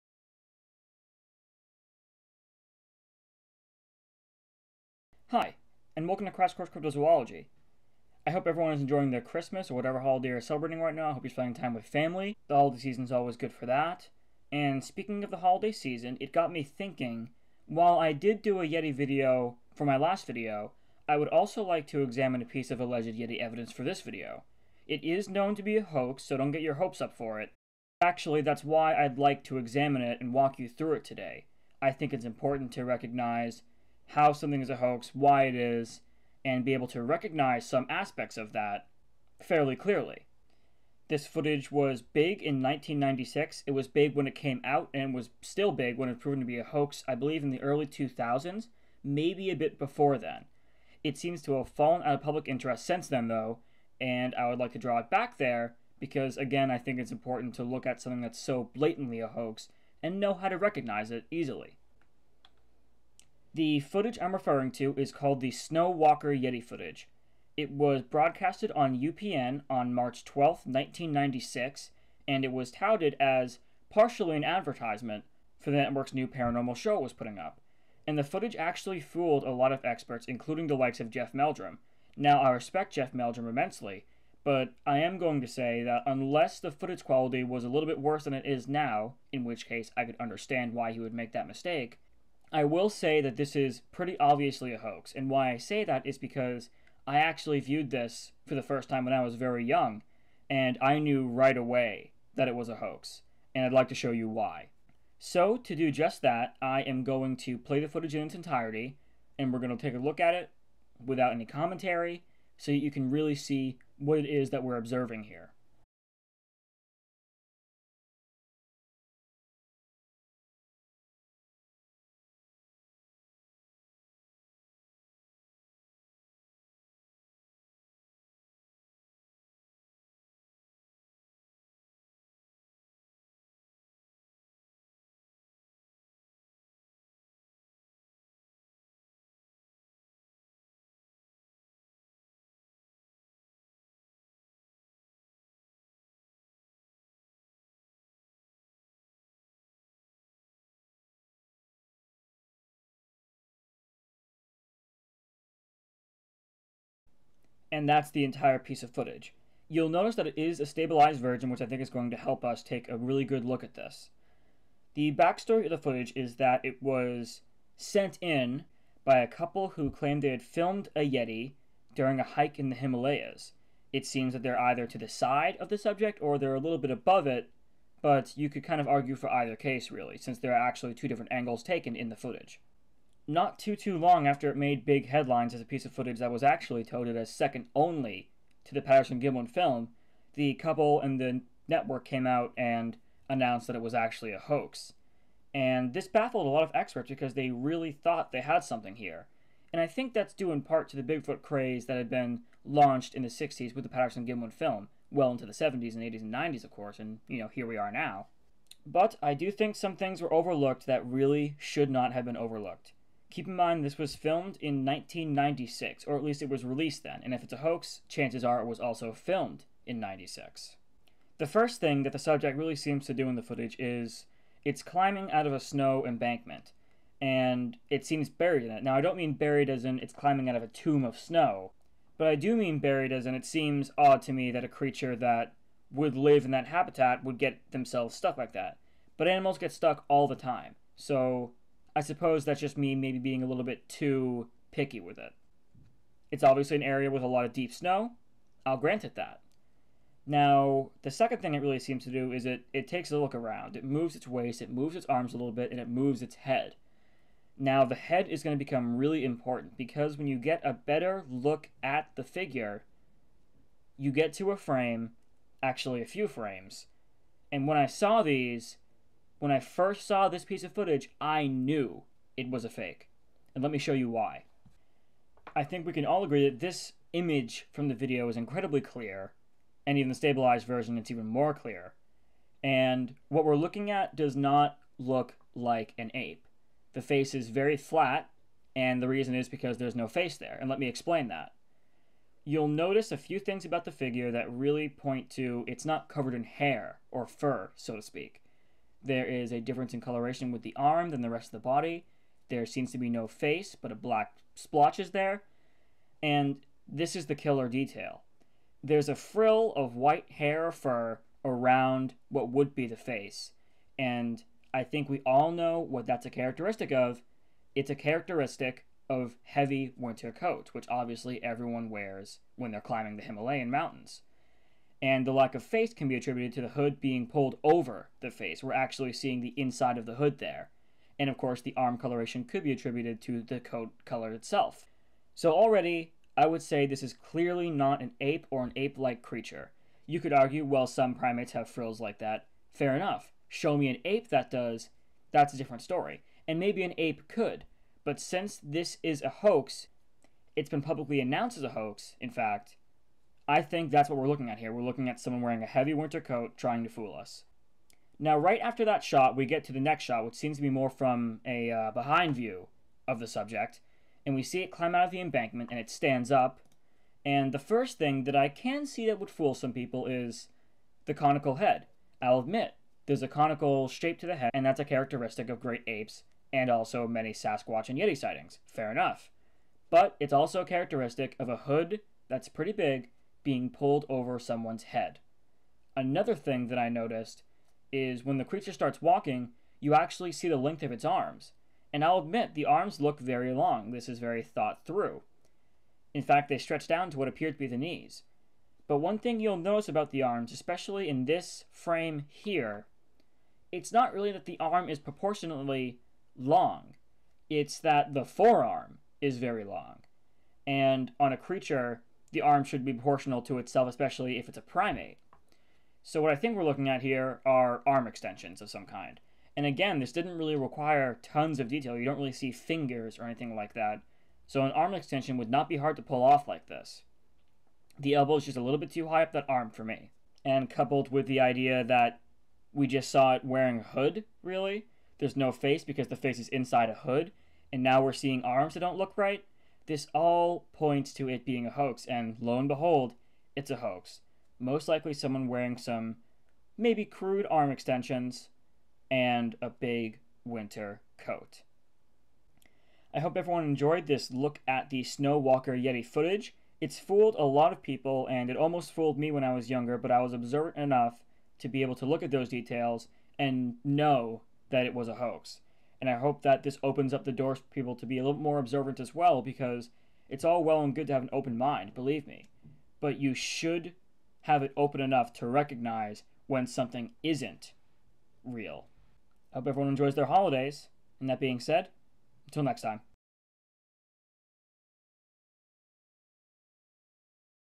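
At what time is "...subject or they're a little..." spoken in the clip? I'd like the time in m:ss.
2:55.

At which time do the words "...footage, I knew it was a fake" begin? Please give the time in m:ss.
4:30.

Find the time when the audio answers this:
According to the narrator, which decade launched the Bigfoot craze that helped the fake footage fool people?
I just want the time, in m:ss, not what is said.
3:23.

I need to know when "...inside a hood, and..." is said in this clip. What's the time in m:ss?
7:16.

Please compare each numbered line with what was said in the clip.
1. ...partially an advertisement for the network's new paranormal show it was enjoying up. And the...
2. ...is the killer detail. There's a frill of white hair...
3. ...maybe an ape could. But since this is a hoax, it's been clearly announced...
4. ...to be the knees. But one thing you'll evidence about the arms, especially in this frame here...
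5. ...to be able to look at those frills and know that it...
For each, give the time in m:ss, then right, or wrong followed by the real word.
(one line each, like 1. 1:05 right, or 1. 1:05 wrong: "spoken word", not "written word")
1. 1:13 wrong: "putting", not "enjoying"
2. 5:07 right
3. 5:46 wrong: "publicly", not "clearly"
4. 6:37 wrong: "notice", not "evidence"
5. 7:41 wrong: "details", not "frills".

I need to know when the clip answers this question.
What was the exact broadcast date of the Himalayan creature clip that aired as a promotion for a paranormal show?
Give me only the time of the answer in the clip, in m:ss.
1:09.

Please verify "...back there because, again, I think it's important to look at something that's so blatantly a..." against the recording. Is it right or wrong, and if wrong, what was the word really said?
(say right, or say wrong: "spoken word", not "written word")
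right.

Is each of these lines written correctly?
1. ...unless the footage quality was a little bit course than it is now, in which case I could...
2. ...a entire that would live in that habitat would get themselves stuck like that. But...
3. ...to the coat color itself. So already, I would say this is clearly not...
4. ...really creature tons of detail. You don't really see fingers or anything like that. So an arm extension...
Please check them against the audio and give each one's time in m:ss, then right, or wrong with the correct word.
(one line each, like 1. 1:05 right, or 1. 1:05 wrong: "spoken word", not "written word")
1. 1:26 wrong: "worse", not "course"
2. 3:54 wrong: "creature", not "entire"
3. 5:33 right
4. 7:00 wrong: "require", not "creature".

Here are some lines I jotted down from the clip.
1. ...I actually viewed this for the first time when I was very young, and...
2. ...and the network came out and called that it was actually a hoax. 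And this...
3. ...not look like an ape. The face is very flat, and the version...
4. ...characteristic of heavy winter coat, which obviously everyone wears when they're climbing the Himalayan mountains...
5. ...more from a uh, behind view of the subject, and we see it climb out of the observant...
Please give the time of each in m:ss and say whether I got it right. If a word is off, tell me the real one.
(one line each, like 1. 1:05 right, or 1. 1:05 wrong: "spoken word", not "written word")
1. 1:37 right
2. 3:11 wrong: "announced", not "called"
3. 4:44 wrong: "reason", not "version"
4. 5:17 right
5. 6:00 wrong: "embankment", not "observant".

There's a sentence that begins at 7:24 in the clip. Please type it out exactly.
Most likely someone wearing some maybe crude arm extensions and a big winter coat.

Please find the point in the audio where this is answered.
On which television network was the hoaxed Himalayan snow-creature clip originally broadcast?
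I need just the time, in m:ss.
1:09.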